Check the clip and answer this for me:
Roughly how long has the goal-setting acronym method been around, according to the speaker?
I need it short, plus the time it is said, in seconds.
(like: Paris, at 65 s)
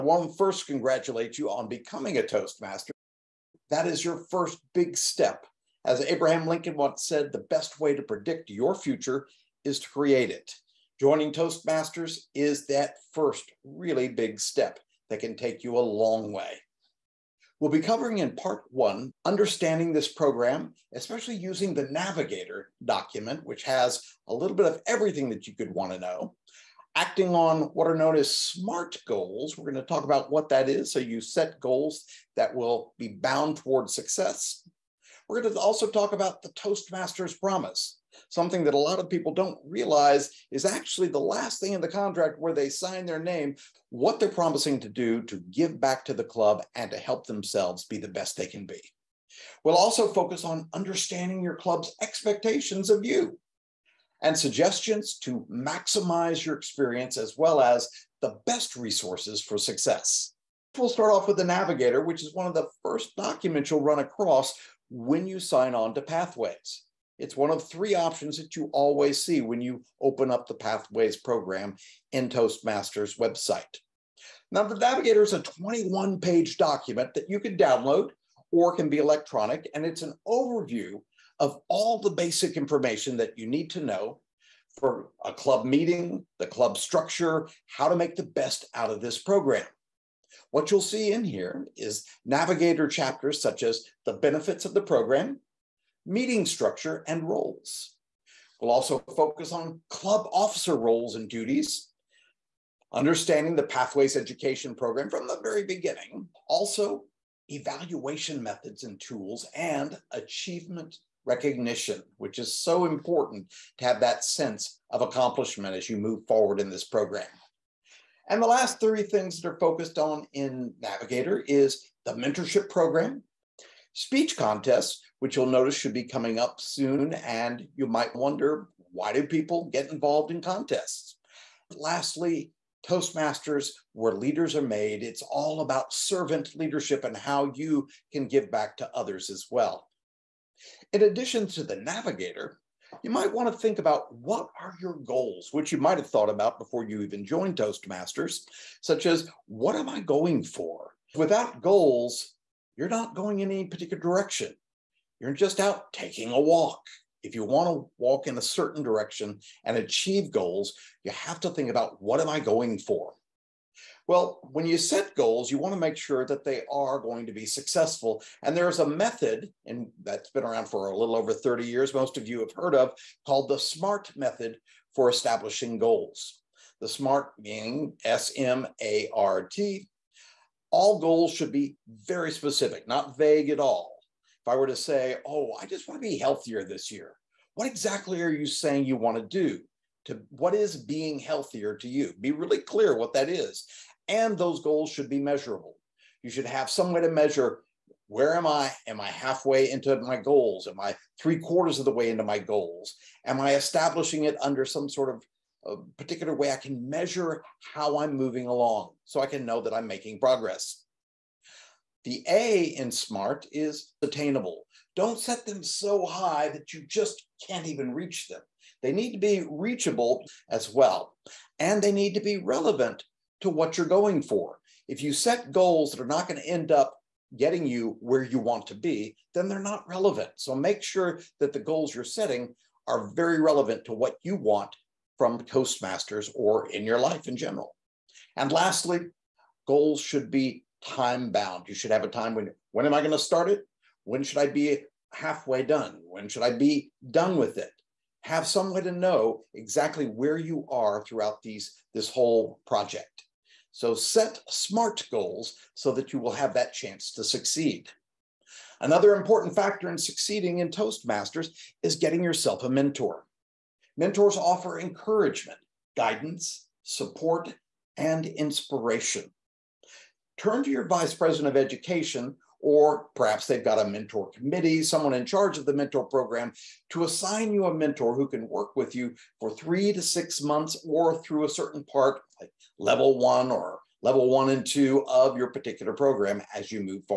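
a little over 30 years, at 170 s.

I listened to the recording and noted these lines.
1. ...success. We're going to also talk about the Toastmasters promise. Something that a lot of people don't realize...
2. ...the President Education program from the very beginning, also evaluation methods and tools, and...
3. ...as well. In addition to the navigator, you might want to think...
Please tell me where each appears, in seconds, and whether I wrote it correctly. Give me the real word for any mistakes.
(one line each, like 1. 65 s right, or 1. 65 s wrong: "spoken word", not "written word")
1. 33 s right
2. 103 s wrong: "Pathways", not "President"
3. 139 s right.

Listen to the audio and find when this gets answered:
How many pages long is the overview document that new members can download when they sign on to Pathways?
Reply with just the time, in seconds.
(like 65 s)
75 s.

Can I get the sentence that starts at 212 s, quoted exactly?
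The A in SMART is attainable.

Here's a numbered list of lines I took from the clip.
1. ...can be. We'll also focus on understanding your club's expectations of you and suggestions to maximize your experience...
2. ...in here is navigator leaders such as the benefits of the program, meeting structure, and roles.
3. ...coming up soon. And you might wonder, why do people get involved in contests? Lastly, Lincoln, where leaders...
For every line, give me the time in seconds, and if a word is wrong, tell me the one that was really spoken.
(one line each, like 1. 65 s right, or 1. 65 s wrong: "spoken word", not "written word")
1. 48 s right
2. 91 s wrong: "chapters", not "leaders"
3. 126 s wrong: "Toastmasters", not "Lincoln".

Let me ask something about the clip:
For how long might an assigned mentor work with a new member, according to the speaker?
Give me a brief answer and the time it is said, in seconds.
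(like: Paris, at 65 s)
3 to 6 months, at 279 s.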